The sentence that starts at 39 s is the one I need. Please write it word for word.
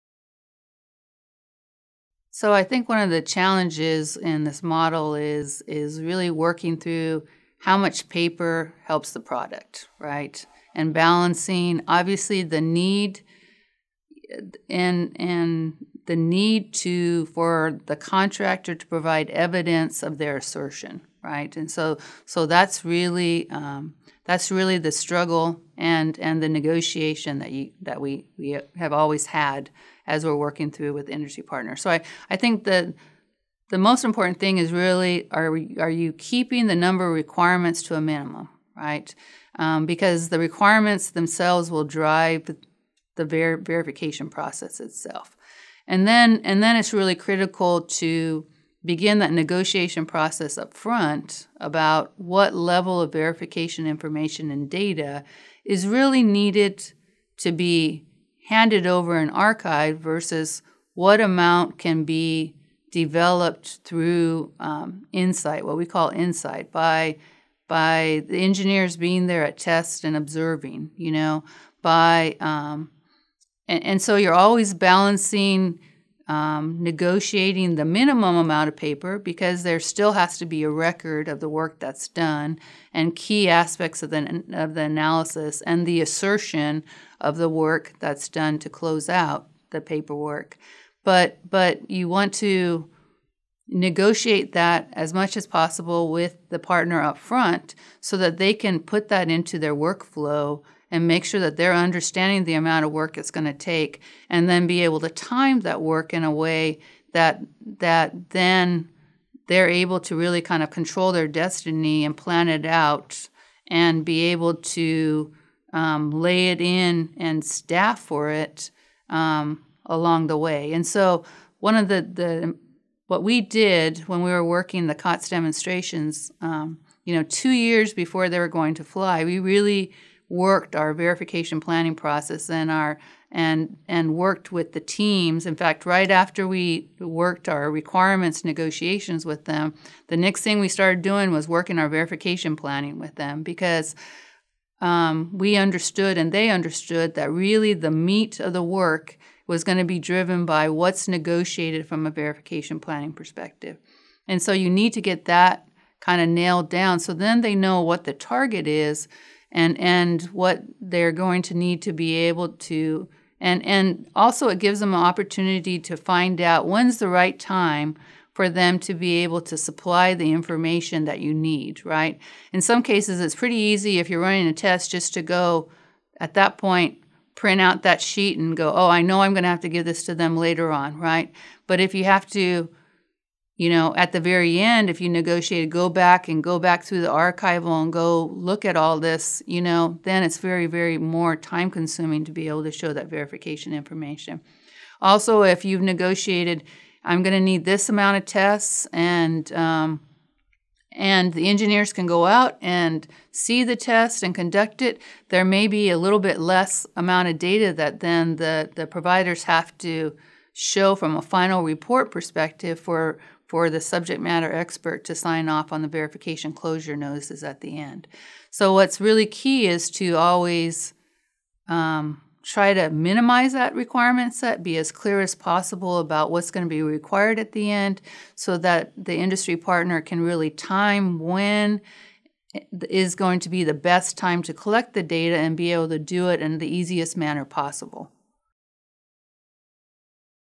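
Um, because the requirements themselves will drive the ver- verification process itself.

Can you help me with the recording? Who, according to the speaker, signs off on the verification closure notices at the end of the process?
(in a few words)
subject matter expert.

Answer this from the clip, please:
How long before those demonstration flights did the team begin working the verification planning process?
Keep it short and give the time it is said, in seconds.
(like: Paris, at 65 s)
2 years, at 127 s.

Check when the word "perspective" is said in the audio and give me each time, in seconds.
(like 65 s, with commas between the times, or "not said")
153 s, 212 s.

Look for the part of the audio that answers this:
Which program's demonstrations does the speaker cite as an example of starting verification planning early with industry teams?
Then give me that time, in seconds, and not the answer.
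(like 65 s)
124 s.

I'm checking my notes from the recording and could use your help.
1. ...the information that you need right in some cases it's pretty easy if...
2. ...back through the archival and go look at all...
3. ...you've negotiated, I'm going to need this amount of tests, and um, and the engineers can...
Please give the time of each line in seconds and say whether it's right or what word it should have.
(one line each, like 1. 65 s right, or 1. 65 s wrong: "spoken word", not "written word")
1. 170 s right
2. 186 s right
3. 195 s right.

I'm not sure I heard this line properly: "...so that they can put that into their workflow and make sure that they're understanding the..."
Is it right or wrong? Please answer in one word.
right.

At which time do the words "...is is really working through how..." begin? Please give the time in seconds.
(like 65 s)
5 s.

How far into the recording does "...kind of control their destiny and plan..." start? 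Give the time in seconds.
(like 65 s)
110 s.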